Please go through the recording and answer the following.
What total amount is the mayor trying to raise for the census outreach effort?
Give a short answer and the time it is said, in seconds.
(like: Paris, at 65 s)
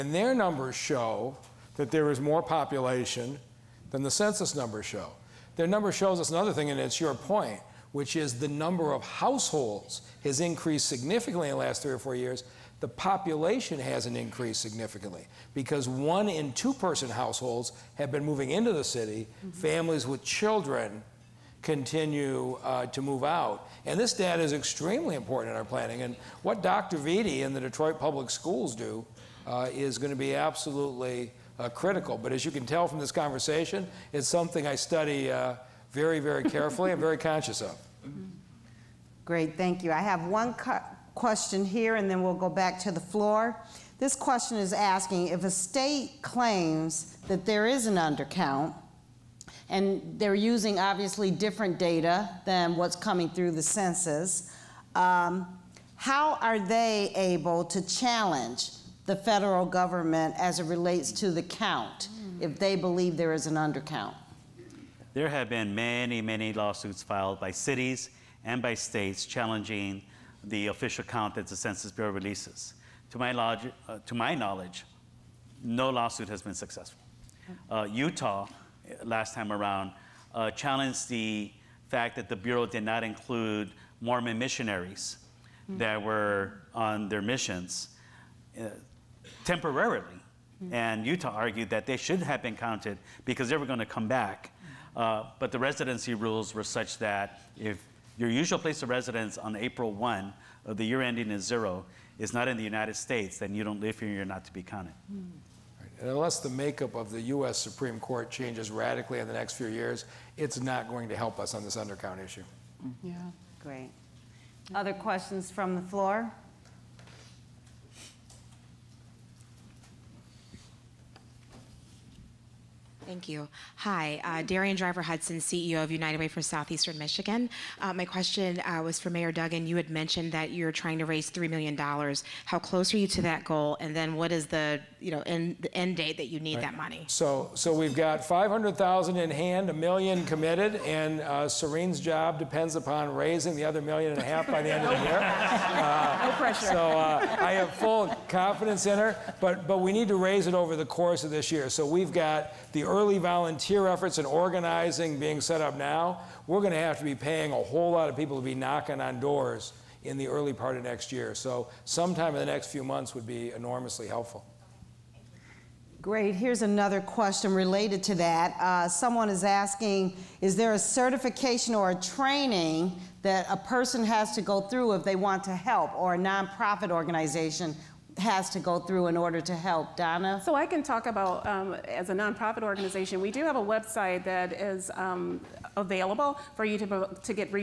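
$3 million, at 131 s.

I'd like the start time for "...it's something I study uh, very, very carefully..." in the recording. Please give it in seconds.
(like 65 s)
34 s.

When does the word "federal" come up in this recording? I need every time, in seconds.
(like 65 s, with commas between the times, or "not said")
59 s.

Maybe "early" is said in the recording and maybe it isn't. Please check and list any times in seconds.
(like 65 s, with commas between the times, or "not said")
152 s, 160 s.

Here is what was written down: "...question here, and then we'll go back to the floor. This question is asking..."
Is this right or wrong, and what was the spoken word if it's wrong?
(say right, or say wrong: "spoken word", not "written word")
right.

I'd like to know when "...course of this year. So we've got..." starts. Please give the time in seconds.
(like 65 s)
150 s.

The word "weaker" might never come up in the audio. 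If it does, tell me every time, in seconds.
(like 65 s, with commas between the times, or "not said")
not said.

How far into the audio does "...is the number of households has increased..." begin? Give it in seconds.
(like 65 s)
8 s.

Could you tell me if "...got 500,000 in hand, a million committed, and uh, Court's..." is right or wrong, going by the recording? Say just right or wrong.
wrong.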